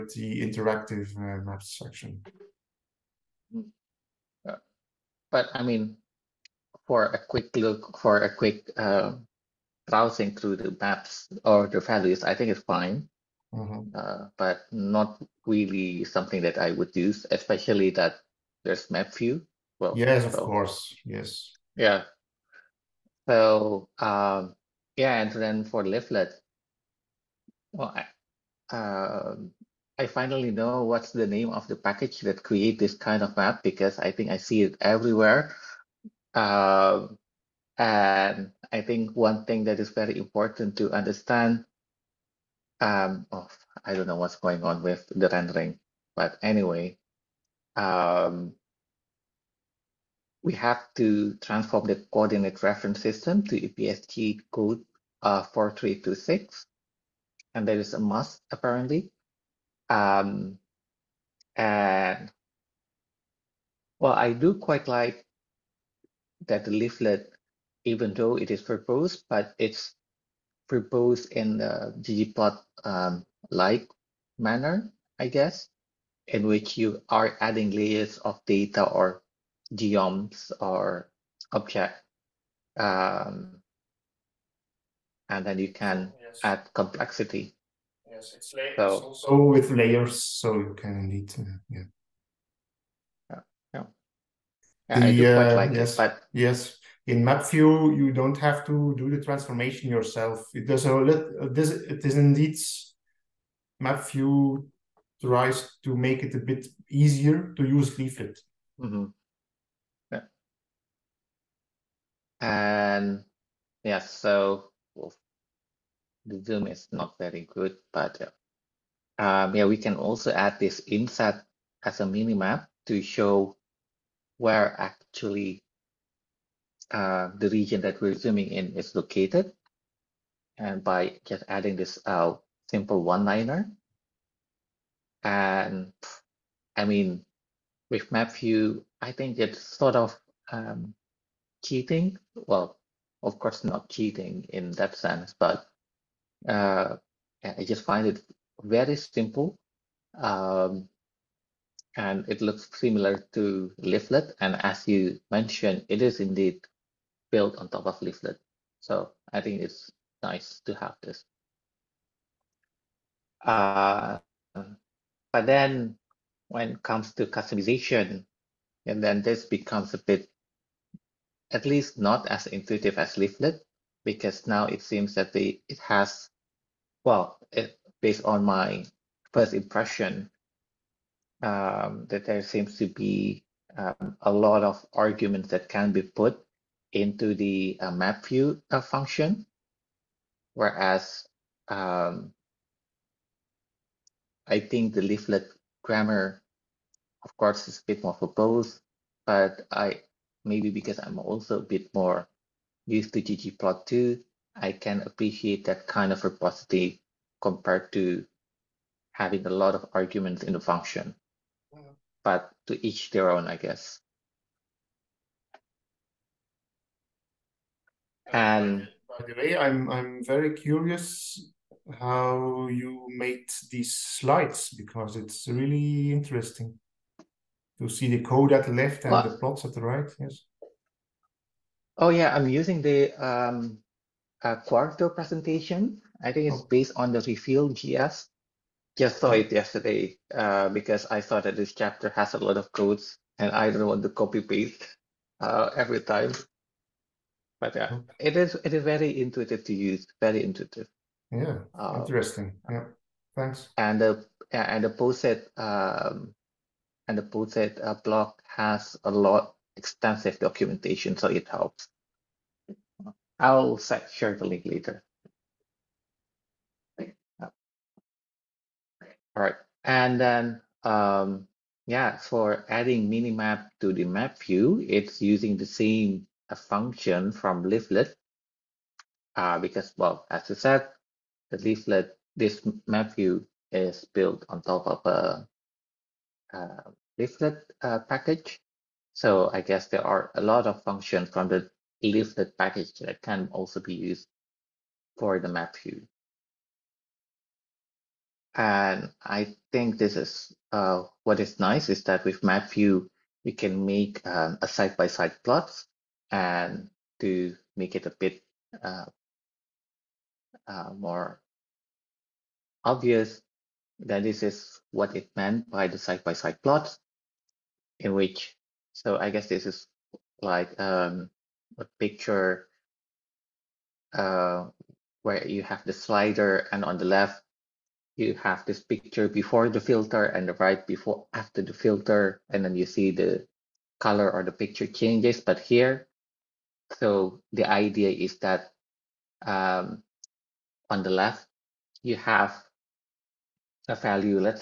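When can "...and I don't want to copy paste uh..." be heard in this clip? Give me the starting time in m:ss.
4:03.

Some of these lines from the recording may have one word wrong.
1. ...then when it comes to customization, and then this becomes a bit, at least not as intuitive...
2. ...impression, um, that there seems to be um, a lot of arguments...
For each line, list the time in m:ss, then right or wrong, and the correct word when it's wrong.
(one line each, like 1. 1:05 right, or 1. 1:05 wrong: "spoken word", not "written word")
1. 2:45 right
2. 2:59 right.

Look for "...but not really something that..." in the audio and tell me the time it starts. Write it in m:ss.
0:14.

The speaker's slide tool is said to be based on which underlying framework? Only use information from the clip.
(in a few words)
Reveal.js.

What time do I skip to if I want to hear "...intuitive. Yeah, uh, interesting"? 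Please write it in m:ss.
4:10.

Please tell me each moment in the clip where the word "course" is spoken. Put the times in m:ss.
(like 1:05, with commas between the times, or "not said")
0:20, 2:23, 3:17.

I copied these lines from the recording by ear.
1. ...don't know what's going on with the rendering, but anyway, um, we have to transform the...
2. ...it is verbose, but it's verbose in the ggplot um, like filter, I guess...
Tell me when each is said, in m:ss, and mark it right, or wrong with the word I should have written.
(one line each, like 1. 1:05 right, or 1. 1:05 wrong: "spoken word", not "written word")
1. 0:43 right
2. 1:08 wrong: "manner", not "filter".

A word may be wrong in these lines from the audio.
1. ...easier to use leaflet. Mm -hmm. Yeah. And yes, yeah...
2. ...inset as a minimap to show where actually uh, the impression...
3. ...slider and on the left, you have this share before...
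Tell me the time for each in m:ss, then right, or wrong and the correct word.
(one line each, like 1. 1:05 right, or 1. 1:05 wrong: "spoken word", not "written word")
1. 1:46 right
2. 2:00 wrong: "region", not "impression"
3. 5:25 wrong: "picture", not "share".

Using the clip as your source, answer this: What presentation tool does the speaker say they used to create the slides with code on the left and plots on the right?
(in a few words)
Quarto.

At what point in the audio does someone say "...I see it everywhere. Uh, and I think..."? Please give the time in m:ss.
0:34.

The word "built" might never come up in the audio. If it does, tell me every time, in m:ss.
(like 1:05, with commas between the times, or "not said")
2:37, 4:44.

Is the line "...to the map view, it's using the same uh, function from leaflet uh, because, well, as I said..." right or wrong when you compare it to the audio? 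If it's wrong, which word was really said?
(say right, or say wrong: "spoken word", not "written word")
right.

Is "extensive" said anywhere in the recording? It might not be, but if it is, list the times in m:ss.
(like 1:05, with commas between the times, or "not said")
4:19.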